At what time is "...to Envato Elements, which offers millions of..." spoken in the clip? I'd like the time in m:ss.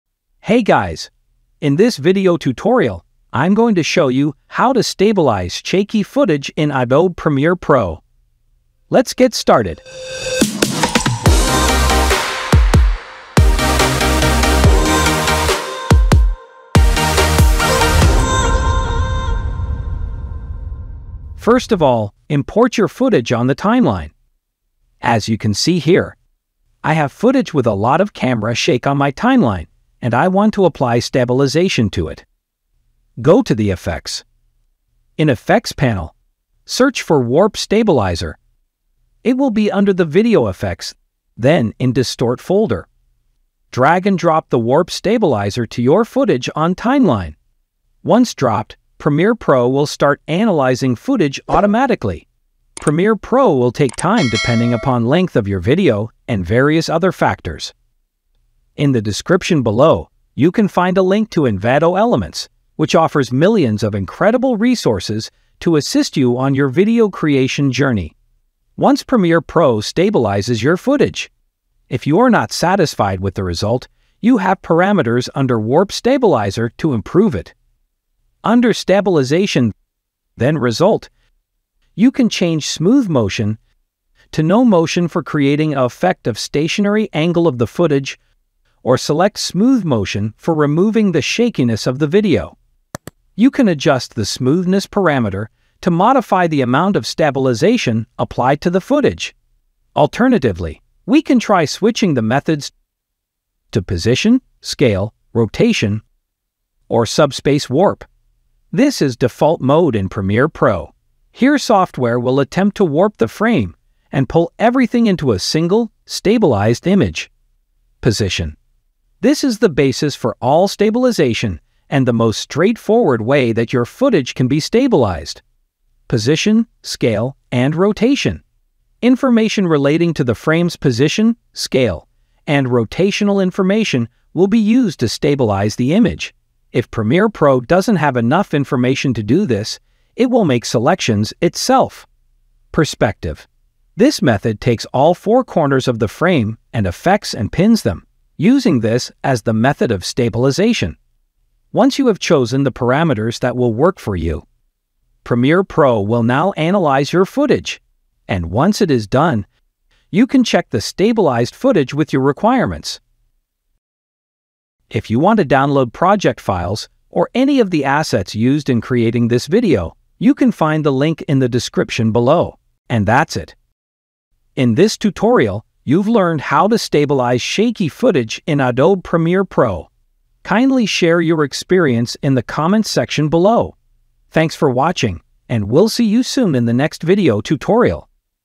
1:01.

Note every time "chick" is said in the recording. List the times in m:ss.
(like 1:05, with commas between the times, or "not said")
not said.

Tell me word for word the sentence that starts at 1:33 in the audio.
You can adjust the smoothness parameter to modify the amount of stabilization applied to the footage.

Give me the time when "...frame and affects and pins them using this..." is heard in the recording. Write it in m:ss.
2:26.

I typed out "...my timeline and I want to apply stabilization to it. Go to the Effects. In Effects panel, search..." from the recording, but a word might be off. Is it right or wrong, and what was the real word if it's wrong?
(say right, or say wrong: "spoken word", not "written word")
right.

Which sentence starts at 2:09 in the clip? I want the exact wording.
Information relating to the frame's position, scale, and rotational information will be used to stabilize the image.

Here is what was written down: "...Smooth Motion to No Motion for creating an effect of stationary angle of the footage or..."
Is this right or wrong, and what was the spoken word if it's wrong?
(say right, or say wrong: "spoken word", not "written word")
right.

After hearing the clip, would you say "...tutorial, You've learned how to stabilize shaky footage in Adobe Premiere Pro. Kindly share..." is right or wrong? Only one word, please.
right.